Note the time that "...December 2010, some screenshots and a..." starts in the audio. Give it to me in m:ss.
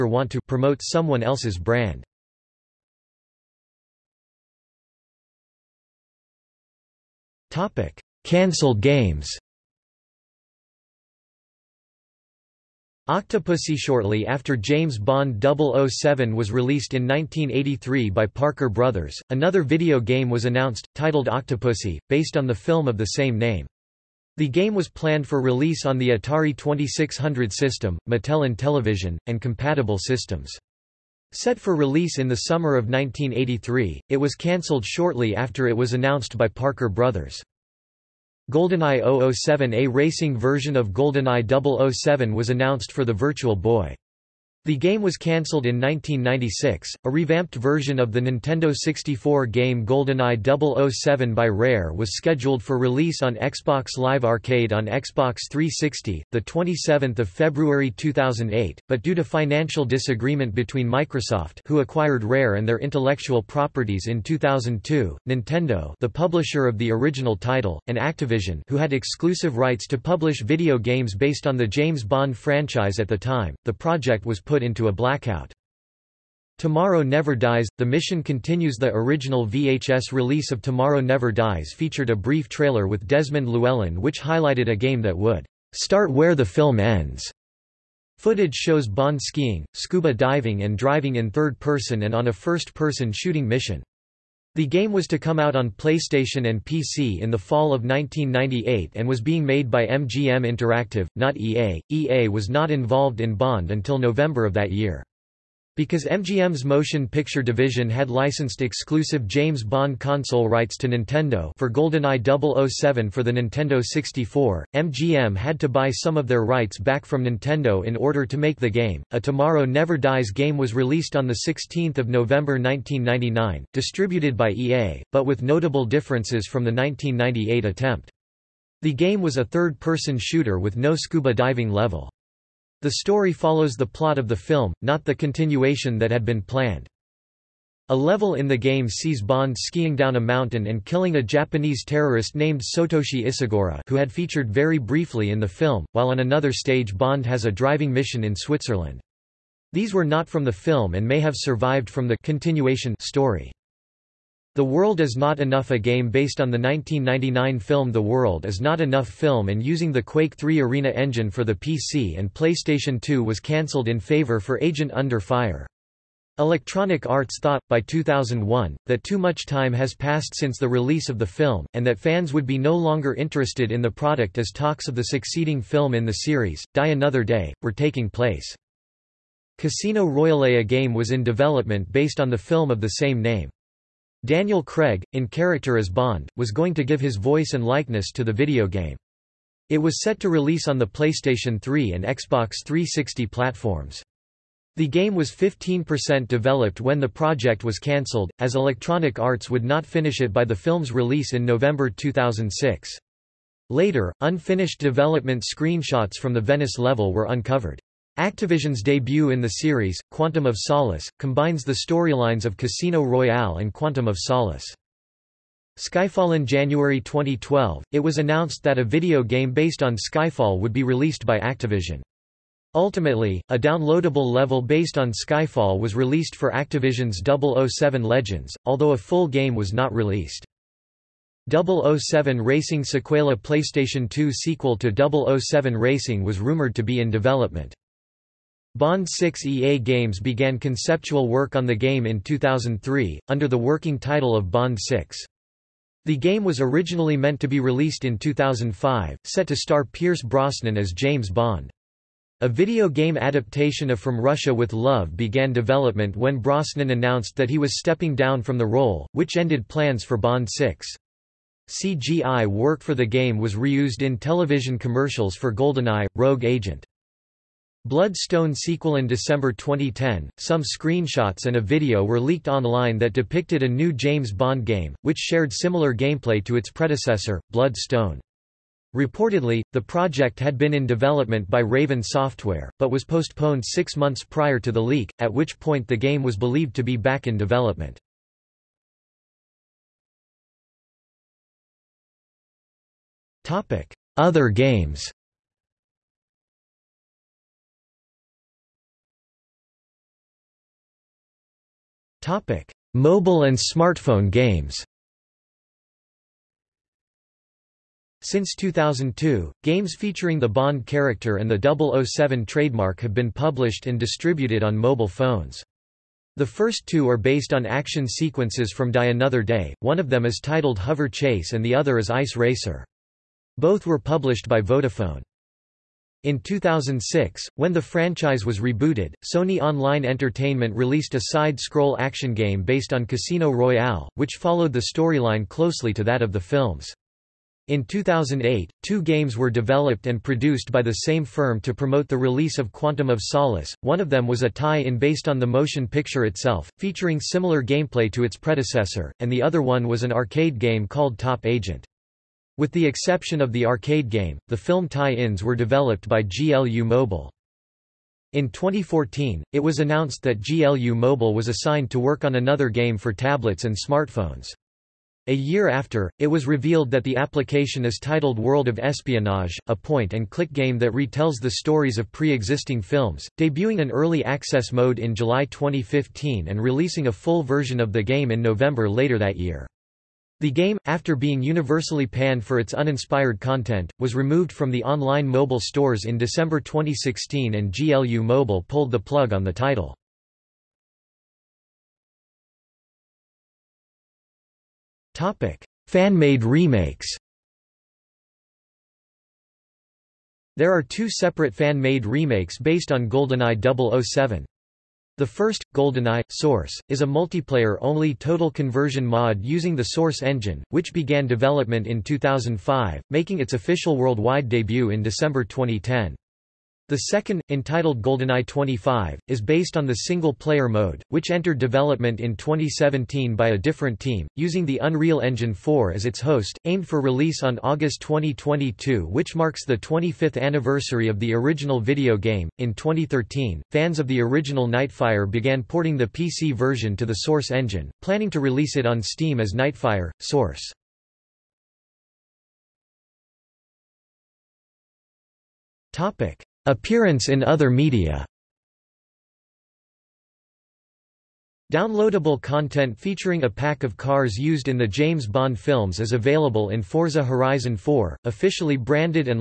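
4:29.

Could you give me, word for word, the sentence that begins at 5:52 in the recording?
With the exception of the arcade game, the film tie-ins were developed by GLU Mobile.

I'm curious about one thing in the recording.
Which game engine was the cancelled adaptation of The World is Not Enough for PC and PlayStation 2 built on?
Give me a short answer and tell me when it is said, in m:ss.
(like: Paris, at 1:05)
Quake 3 Arena engine, at 2:40.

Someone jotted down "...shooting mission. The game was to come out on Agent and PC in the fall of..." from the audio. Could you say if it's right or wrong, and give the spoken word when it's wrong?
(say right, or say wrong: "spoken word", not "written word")
wrong: "PlayStation", not "Agent".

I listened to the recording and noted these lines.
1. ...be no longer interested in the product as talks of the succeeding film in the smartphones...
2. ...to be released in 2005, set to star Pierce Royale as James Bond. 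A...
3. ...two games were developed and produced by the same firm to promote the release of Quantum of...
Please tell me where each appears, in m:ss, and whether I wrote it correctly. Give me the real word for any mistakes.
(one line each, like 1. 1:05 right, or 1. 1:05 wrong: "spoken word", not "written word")
1. 2:52 wrong: "series", not "smartphones"
2. 4:07 wrong: "Brosnan", not "Royale"
3. 5:38 right.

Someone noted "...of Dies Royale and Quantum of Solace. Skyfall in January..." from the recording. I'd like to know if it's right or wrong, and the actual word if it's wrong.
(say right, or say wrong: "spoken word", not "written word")
wrong: "Casino", not "Dies".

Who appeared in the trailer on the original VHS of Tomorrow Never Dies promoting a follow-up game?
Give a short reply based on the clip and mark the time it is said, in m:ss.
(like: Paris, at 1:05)
Desmond Llewellyn, at 1:23.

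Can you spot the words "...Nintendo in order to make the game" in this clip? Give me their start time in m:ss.
1:57.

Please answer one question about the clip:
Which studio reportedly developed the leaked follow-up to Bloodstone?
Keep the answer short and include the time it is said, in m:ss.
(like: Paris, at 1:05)
Raven Software, at 4:41.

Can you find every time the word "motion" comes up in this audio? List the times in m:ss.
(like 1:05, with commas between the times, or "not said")
1:46, 5:45.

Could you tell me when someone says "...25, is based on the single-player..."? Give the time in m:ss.
6:58.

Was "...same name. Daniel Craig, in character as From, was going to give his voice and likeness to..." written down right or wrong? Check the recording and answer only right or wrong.
wrong.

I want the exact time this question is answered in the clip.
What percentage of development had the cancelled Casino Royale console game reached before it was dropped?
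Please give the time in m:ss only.
3:15.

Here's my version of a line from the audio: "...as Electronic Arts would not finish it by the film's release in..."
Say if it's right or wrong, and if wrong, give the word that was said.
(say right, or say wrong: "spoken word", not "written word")
right.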